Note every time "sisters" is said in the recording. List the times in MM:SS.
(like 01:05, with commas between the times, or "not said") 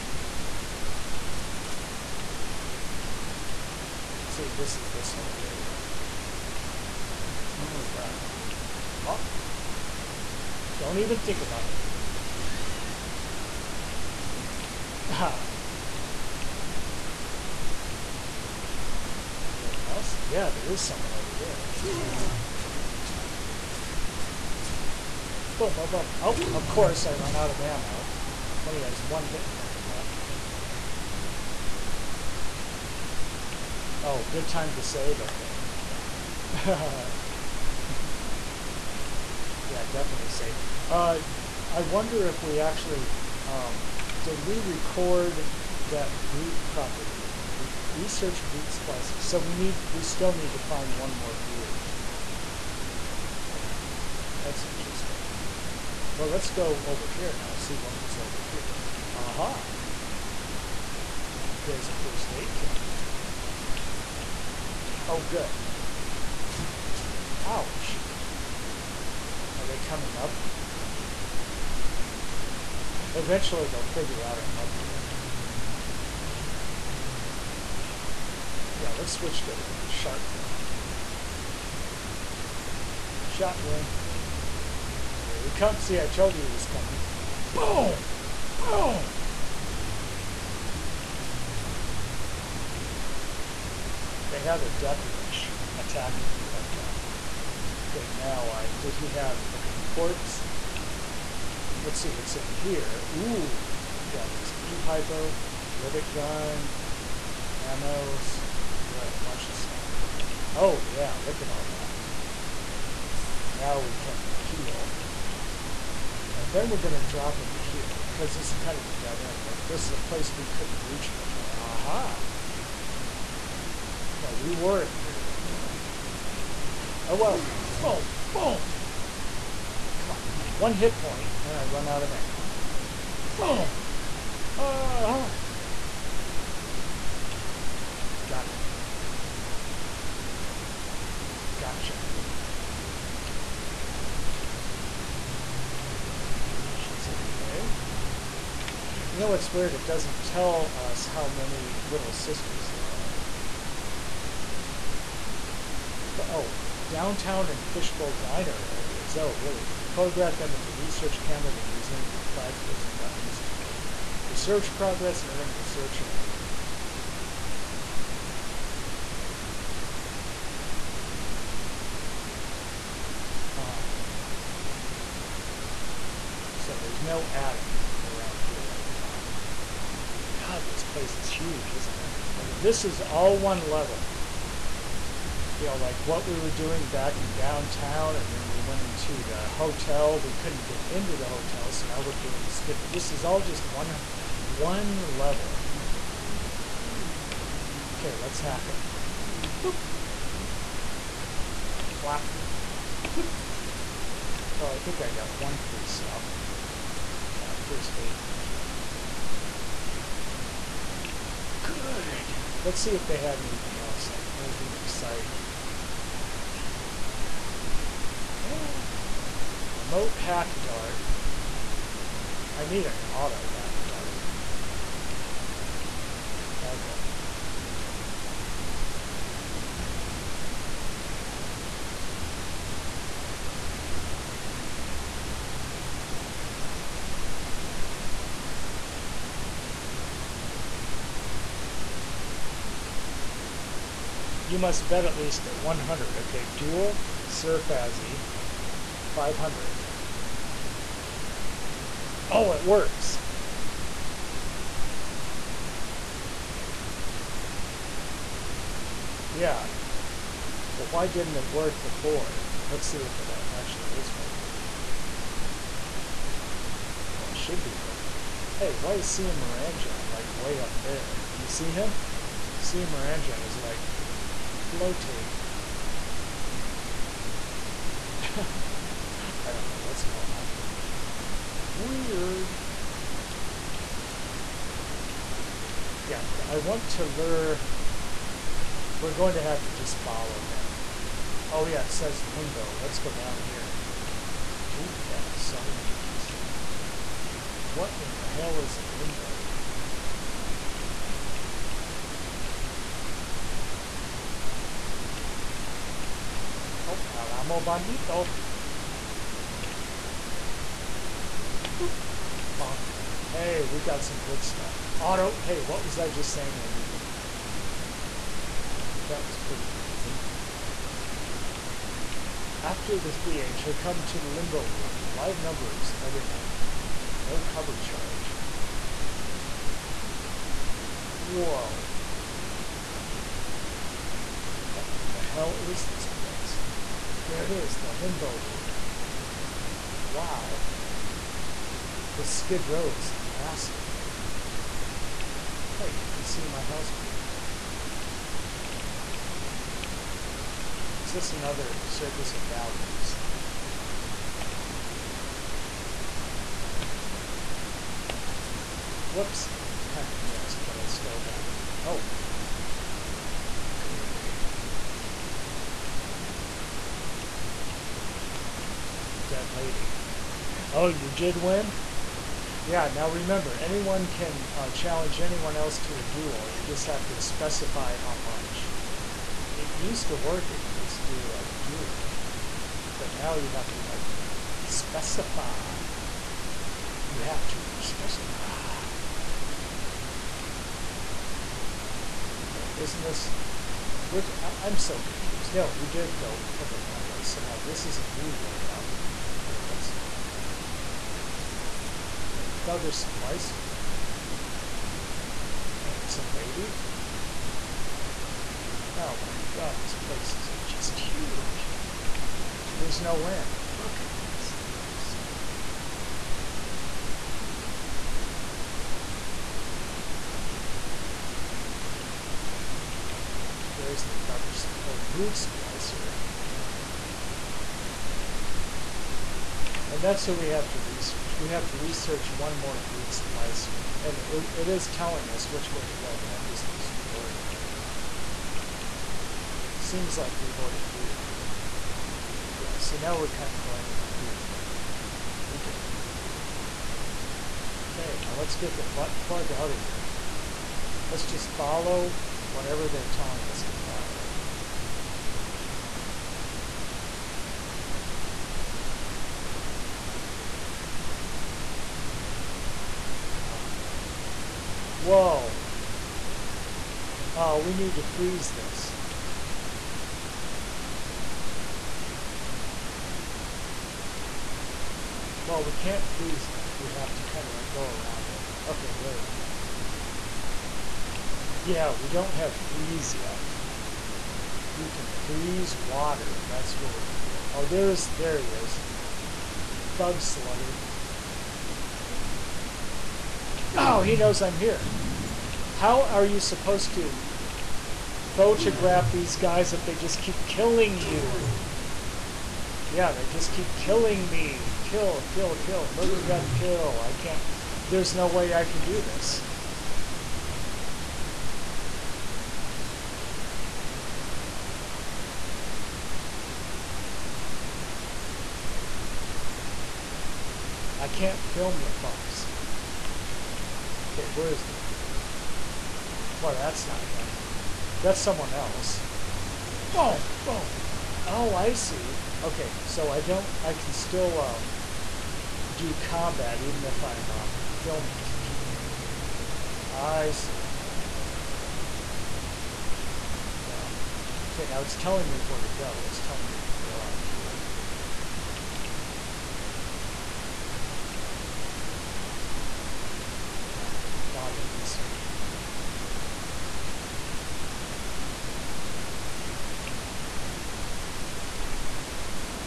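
02:32.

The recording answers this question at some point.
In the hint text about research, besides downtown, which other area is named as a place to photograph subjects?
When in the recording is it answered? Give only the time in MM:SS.
02:37.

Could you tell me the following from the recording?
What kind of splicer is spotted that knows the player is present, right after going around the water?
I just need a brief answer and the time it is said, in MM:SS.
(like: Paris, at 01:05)
Thug Slugger, at 08:09.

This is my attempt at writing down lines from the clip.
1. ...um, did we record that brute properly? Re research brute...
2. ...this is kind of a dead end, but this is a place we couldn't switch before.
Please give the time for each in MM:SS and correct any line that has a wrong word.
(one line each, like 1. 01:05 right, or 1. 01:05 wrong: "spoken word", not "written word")
1. 00:43 right
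2. 01:58 wrong: "reach", not "switch".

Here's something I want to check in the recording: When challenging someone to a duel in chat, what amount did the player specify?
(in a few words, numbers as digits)
500.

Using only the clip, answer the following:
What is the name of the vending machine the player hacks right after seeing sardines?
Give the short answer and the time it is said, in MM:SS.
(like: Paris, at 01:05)
El Ammo Bandito, at 05:07.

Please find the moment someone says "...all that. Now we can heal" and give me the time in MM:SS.
01:51.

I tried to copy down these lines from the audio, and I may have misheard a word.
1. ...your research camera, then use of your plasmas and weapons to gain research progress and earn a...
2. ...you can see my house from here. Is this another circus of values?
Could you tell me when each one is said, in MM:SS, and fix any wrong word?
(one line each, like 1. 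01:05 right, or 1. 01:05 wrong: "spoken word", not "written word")
1. 02:40 right
2. 05:46 right.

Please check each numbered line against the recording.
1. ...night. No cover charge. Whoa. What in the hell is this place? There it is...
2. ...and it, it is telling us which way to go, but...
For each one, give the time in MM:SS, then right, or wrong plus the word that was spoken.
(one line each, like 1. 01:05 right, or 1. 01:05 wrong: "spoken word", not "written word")
1. 05:26 right
2. 07:14 right.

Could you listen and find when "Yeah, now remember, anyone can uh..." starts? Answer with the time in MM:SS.
06:12.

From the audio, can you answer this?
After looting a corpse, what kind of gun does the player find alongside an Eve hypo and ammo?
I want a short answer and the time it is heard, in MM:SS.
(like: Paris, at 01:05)
Rivet gun, at 01:45.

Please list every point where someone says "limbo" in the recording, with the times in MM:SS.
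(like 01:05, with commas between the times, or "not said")
04:52, 04:58, 05:24, 05:37.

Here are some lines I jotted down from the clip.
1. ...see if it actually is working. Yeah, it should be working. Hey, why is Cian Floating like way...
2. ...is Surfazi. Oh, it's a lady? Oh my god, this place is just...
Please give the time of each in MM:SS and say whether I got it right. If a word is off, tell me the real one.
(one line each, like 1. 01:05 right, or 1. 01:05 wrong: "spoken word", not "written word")
1. 04:22 wrong: "Moranjan", not "Floating"
2. 06:42 wrong: "Splicer", not "Surfazi".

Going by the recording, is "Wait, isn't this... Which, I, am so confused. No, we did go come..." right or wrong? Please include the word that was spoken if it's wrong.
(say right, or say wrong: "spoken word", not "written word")
right.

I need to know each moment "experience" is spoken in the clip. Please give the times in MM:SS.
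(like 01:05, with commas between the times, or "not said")
not said.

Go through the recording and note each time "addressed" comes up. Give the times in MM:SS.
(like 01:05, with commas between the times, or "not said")
not said.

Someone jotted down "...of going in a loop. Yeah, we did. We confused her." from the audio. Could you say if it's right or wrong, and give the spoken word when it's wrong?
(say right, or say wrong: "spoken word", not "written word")
wrong: "looted", not "confused".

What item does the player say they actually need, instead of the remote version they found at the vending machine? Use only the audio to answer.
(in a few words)
Auto hack dart.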